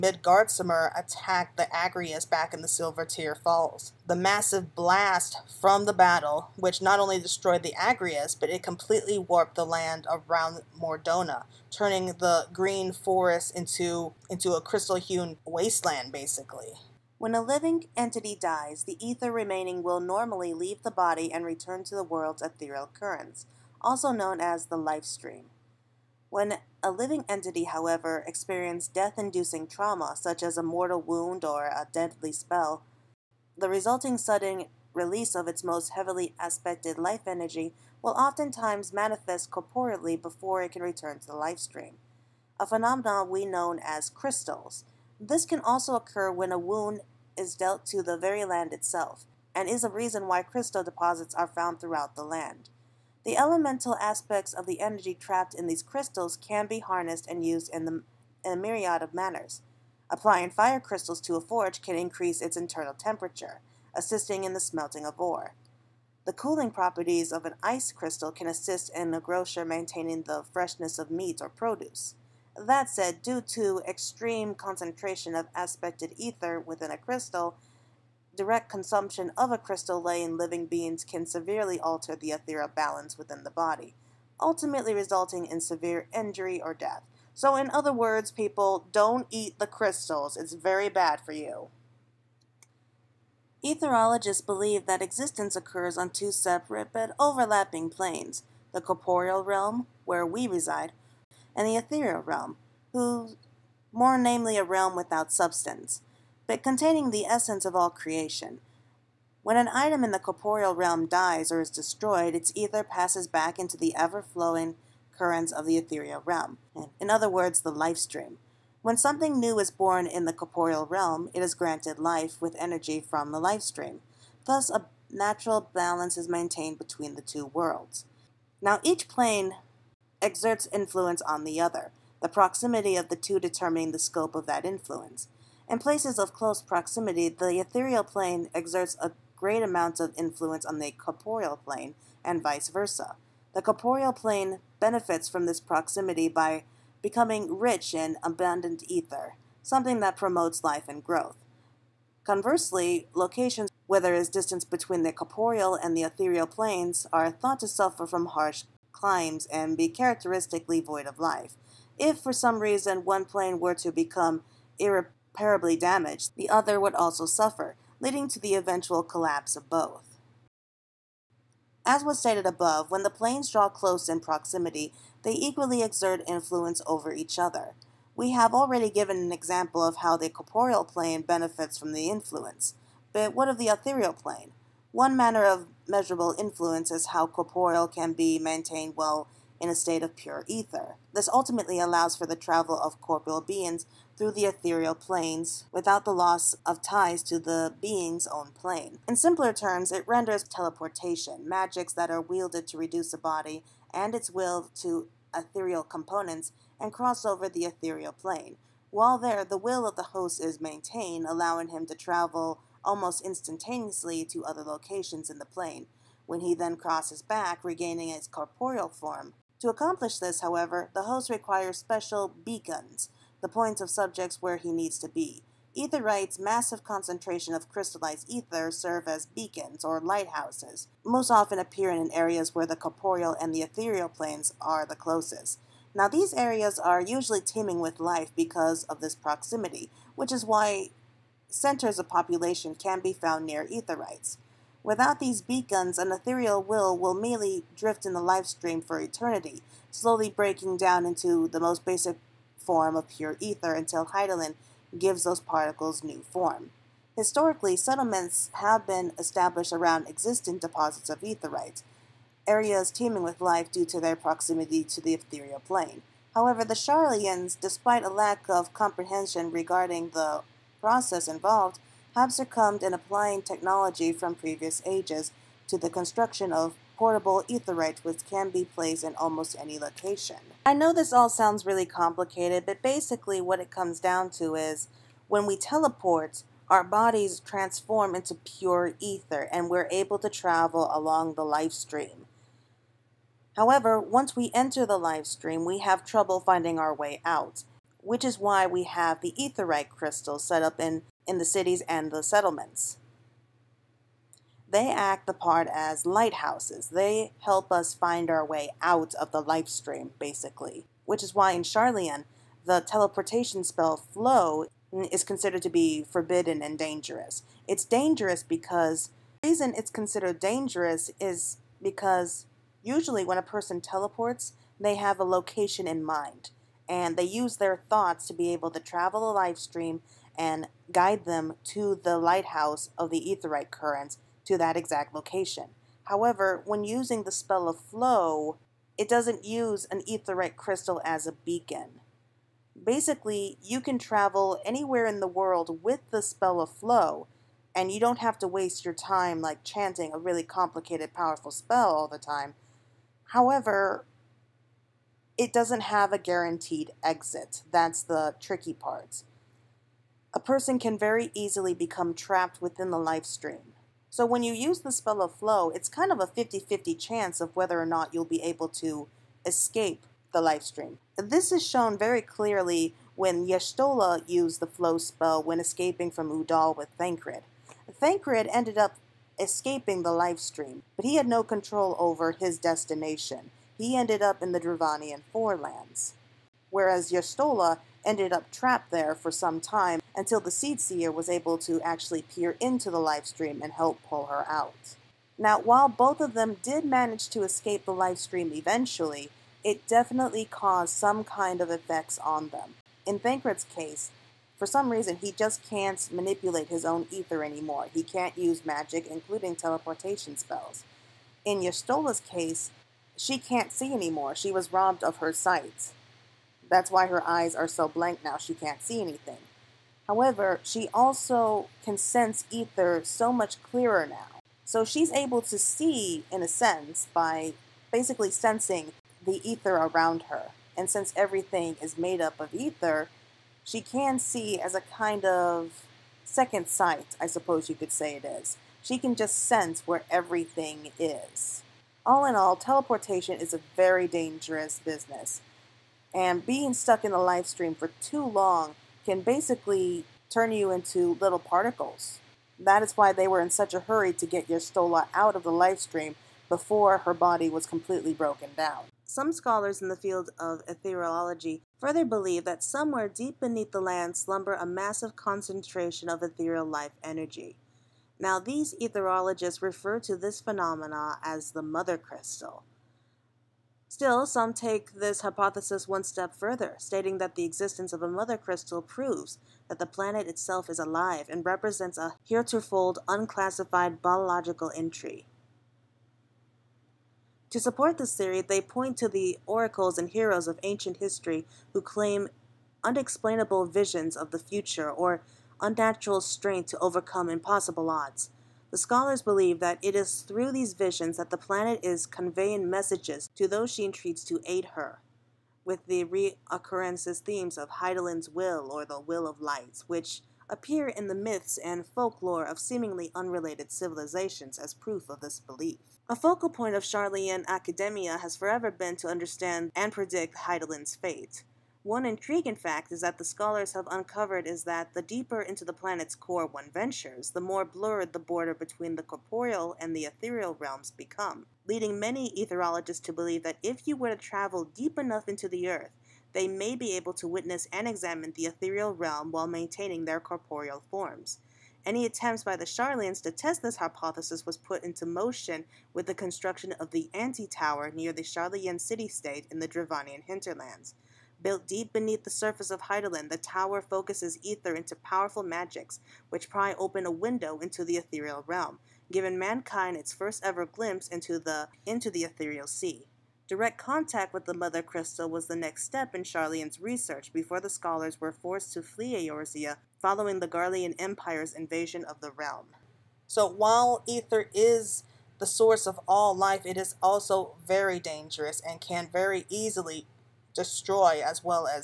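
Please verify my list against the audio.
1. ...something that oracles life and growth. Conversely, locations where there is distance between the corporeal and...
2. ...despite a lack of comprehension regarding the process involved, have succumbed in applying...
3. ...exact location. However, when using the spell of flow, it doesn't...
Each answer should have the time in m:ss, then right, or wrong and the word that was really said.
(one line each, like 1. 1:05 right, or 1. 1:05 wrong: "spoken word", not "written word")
1. 2:29 wrong: "promotes", not "oracles"
2. 4:27 right
3. 5:34 right.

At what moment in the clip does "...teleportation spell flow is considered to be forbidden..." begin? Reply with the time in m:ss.
5:12.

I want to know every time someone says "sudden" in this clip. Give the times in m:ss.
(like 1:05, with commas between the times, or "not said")
0:34.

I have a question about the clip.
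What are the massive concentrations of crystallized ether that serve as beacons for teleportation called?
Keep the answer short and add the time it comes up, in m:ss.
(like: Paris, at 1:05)
Etherites, at 4:03.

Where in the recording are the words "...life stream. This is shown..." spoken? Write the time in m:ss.
6:10.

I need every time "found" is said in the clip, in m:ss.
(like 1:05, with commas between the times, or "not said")
0:51, 4:03.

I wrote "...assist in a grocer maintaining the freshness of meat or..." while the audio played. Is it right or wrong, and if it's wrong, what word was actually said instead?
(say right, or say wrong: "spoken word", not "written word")
right.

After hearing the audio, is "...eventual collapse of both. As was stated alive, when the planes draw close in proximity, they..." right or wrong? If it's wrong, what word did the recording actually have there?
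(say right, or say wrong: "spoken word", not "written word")
wrong: "above", not "alive".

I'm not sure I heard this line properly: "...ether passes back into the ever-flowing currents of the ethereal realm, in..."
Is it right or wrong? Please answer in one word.
right.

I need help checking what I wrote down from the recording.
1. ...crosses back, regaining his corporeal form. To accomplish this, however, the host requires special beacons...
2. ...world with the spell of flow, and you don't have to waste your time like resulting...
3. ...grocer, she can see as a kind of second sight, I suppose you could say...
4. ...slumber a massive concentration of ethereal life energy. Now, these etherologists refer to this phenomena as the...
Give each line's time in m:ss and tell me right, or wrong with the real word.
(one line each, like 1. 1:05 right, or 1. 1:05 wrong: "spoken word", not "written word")
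1. 3:36 right
2. 5:45 wrong: "chanting", not "resulting"
3. 7:12 wrong: "ether", not "grocer"
4. 7:44 right.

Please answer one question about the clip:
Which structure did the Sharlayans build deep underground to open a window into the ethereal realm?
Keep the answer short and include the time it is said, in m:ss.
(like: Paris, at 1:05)
The Anti Tower, at 9:06.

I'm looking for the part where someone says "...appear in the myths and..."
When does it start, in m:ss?
8:30.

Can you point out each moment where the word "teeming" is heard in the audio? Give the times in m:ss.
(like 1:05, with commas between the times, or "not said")
3:57, 4:22.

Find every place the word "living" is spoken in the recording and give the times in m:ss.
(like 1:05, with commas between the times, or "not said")
0:17, 0:26, 1:20.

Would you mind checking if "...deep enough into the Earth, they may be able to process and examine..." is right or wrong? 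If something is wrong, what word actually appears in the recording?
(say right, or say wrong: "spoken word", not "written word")
wrong: "witness", not "process".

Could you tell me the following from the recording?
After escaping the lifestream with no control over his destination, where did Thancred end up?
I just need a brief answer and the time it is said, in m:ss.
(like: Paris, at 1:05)
Dravanian forelands, at 6:24.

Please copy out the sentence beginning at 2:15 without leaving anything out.
In places of close proximity, the ethereal plane exerts a great amount of influence on the corporeal plane, and vice versa.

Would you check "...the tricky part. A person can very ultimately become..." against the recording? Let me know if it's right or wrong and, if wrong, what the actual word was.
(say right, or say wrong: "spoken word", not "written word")
wrong: "easily", not "ultimately".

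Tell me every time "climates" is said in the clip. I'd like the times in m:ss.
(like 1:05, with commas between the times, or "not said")
2:38.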